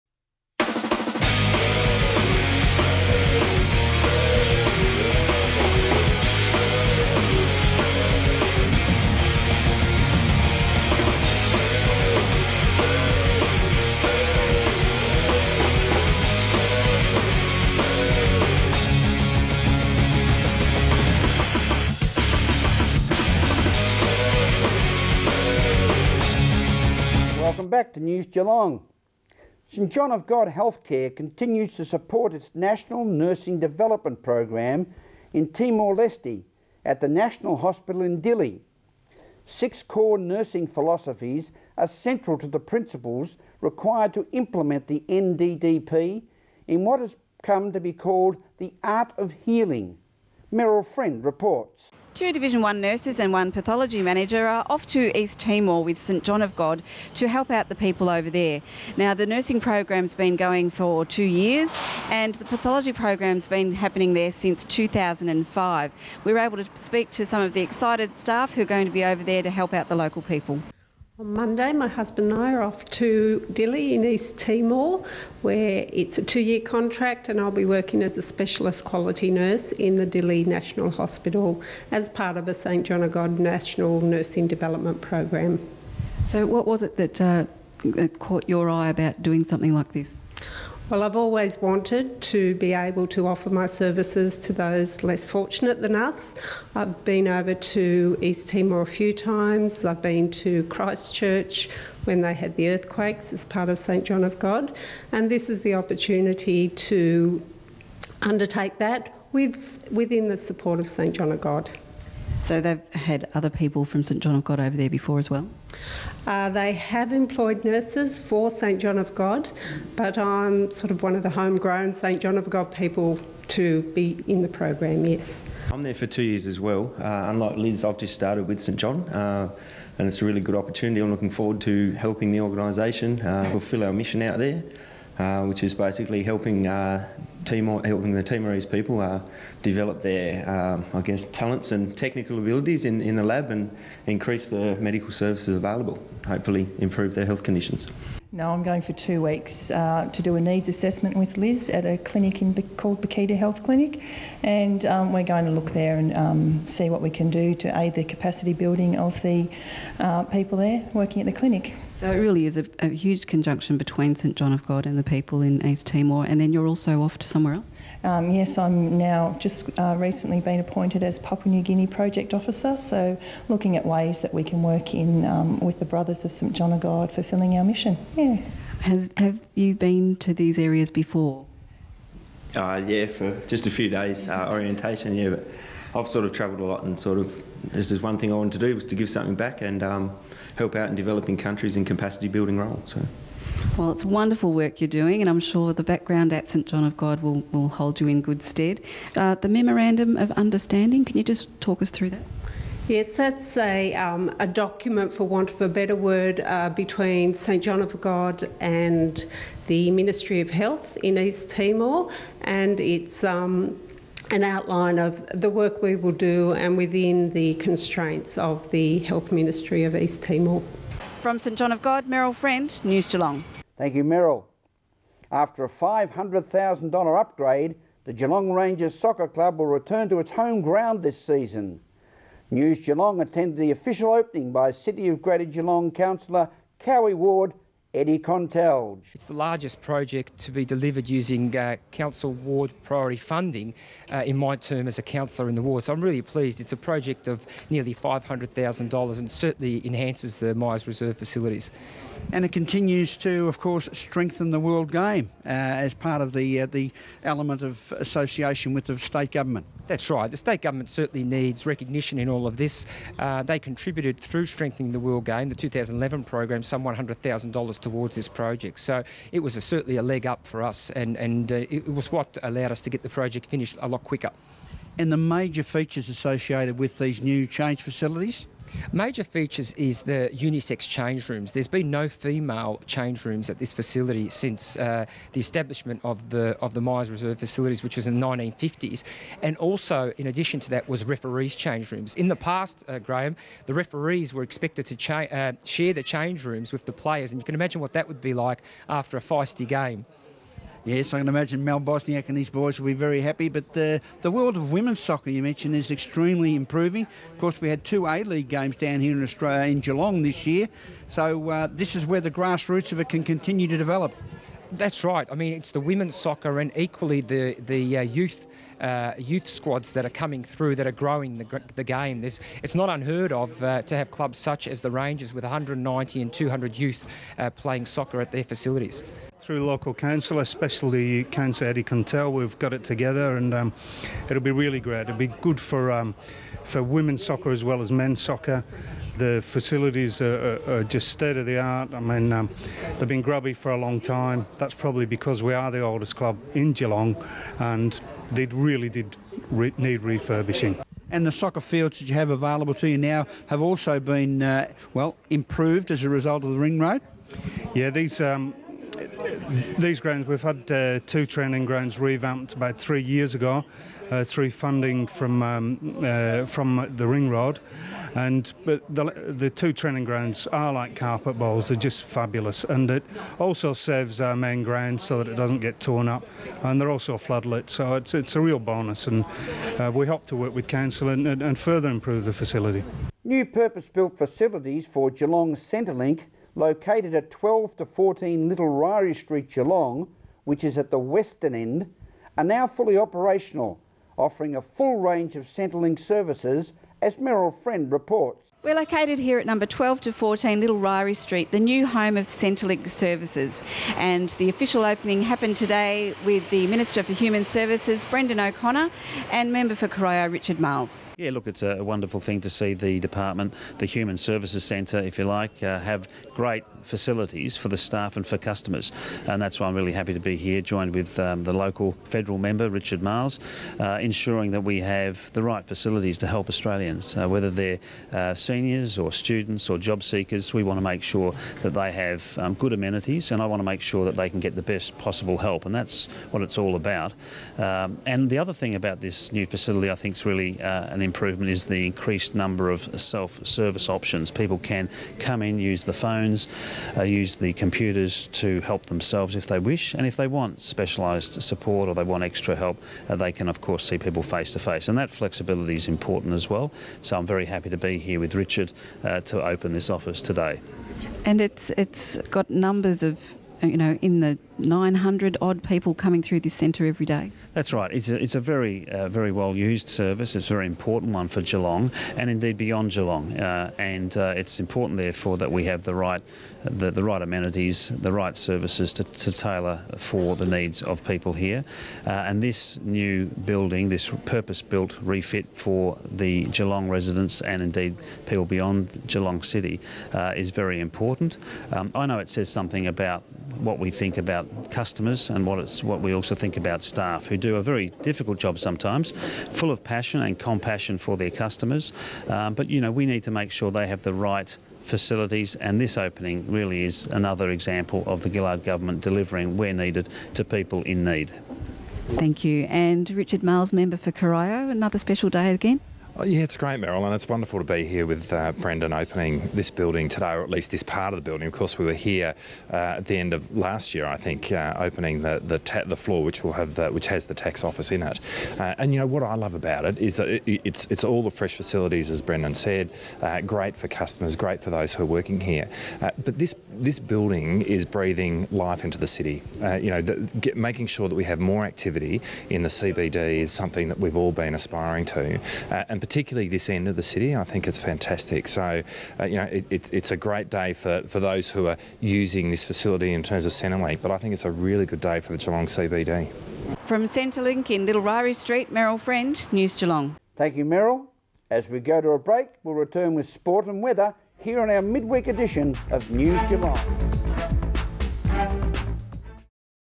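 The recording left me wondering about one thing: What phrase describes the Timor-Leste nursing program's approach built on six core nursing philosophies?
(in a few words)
the art of healing.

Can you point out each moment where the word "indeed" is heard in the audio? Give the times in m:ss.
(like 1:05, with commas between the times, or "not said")
7:52, 8:07.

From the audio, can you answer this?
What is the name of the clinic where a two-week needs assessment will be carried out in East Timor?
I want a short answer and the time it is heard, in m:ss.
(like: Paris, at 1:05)
Bakhita Health Clinic, at 2:33.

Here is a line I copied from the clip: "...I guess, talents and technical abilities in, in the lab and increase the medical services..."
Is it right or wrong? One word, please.
right.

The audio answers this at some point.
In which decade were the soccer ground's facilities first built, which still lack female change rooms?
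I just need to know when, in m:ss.
4:48.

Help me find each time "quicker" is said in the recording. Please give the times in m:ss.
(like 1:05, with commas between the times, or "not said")
4:34.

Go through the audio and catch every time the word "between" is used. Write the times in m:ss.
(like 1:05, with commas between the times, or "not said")
2:43, 3:26.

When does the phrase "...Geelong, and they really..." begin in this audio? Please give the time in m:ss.
5:46.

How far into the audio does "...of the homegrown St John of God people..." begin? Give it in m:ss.
2:01.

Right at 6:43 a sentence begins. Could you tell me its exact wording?
And the official opening happened today with the Minister for Human Services, Brendan O'Connor, and Member for Corio, Richard Marles.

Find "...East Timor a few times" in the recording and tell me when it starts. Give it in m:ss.
1:38.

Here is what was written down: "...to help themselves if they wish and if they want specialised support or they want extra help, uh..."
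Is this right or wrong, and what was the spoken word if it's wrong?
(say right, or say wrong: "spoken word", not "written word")
right.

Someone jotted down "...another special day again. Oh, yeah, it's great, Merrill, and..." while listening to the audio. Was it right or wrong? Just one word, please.
right.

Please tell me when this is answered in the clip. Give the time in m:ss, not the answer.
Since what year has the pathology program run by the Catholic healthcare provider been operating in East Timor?
1:04.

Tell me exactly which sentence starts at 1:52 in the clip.
So they've had other people from St John of God over there before as well?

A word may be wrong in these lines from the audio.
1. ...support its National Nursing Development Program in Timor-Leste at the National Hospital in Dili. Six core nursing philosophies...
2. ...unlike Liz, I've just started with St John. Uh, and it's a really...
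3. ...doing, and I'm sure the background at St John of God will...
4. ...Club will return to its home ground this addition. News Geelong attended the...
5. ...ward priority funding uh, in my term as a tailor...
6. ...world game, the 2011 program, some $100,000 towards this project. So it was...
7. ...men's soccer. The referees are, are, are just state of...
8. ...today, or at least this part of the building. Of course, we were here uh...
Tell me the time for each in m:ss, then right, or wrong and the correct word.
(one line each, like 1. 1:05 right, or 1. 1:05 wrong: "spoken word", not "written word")
1. 0:31 right
2. 2:07 right
3. 3:14 right
4. 3:49 wrong: "season", not "addition"
5. 4:02 wrong: "councillor", not "tailor"
6. 4:24 right
7. 5:37 wrong: "facilities", not "referees"
8. 8:40 right.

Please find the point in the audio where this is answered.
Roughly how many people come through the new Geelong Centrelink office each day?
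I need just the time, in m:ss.
7:44.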